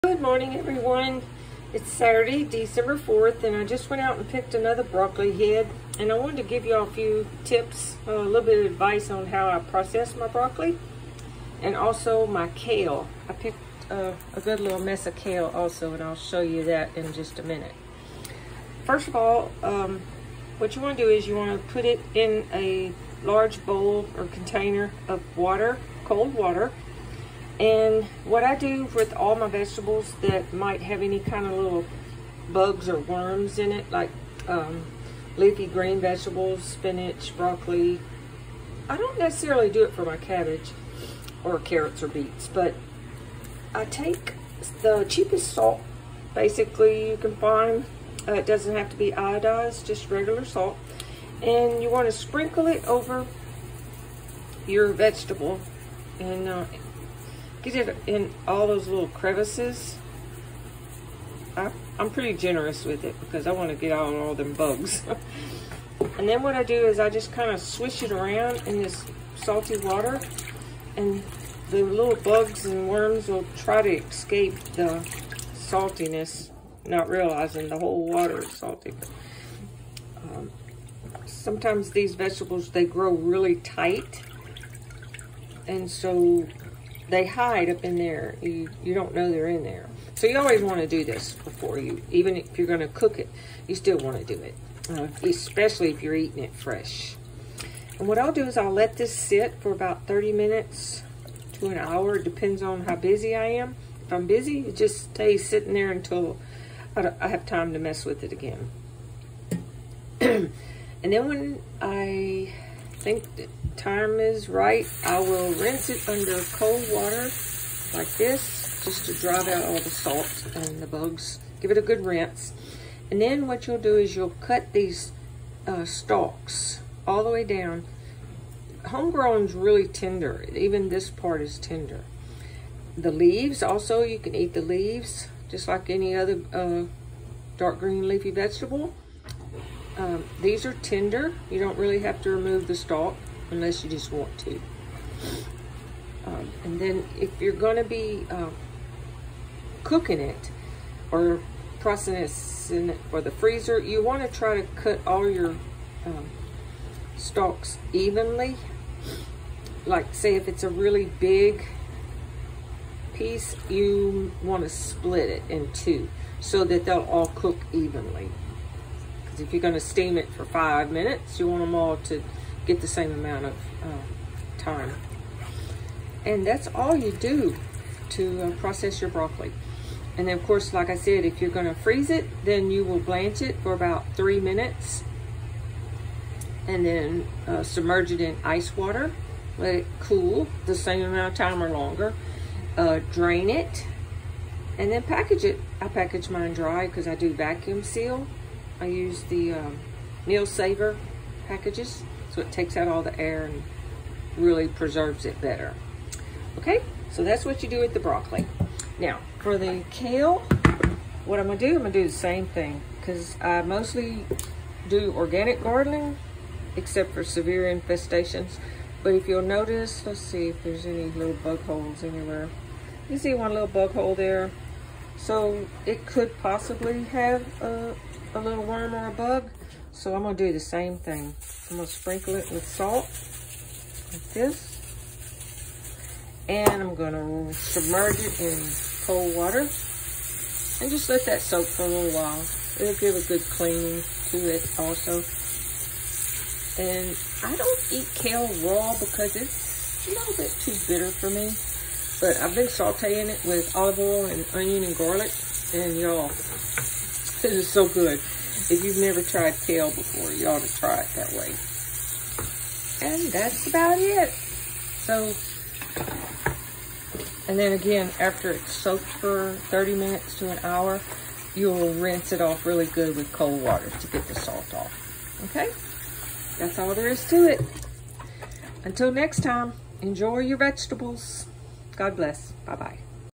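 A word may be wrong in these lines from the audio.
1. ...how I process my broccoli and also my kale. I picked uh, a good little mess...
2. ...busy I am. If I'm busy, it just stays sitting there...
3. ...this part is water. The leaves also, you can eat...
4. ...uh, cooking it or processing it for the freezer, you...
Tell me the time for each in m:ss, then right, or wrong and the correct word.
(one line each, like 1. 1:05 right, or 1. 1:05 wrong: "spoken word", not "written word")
1. 0:09 right
2. 1:42 right
3. 2:10 wrong: "tender", not "water"
4. 2:28 right.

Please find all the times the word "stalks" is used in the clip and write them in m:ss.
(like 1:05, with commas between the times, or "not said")
2:05, 2:22, 2:37.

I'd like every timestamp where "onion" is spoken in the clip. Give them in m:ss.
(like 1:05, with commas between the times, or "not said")
4:14.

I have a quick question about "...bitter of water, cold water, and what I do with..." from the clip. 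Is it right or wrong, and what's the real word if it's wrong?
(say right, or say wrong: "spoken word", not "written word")
wrong: "container", not "bitter".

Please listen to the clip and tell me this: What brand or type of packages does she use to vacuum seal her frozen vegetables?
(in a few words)
Meal saver.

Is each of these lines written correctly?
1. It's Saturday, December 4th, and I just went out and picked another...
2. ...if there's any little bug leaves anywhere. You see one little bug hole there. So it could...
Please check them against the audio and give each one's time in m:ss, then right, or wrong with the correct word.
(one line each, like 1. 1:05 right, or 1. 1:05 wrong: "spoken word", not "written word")
1. 0:01 right
2. 3:40 wrong: "holes", not "leaves".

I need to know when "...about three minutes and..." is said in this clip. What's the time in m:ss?
3:03.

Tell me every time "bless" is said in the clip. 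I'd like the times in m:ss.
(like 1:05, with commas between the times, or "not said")
4:42.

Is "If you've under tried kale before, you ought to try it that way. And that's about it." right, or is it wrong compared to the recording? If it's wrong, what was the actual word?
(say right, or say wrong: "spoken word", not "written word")
wrong: "never", not "under".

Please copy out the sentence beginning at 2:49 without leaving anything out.
Because if you're going to steam it for five minutes, you want them all to get the same amount of uh, time.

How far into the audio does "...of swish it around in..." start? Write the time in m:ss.
1:07.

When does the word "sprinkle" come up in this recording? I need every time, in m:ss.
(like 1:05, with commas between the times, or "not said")
0:52, 3:51.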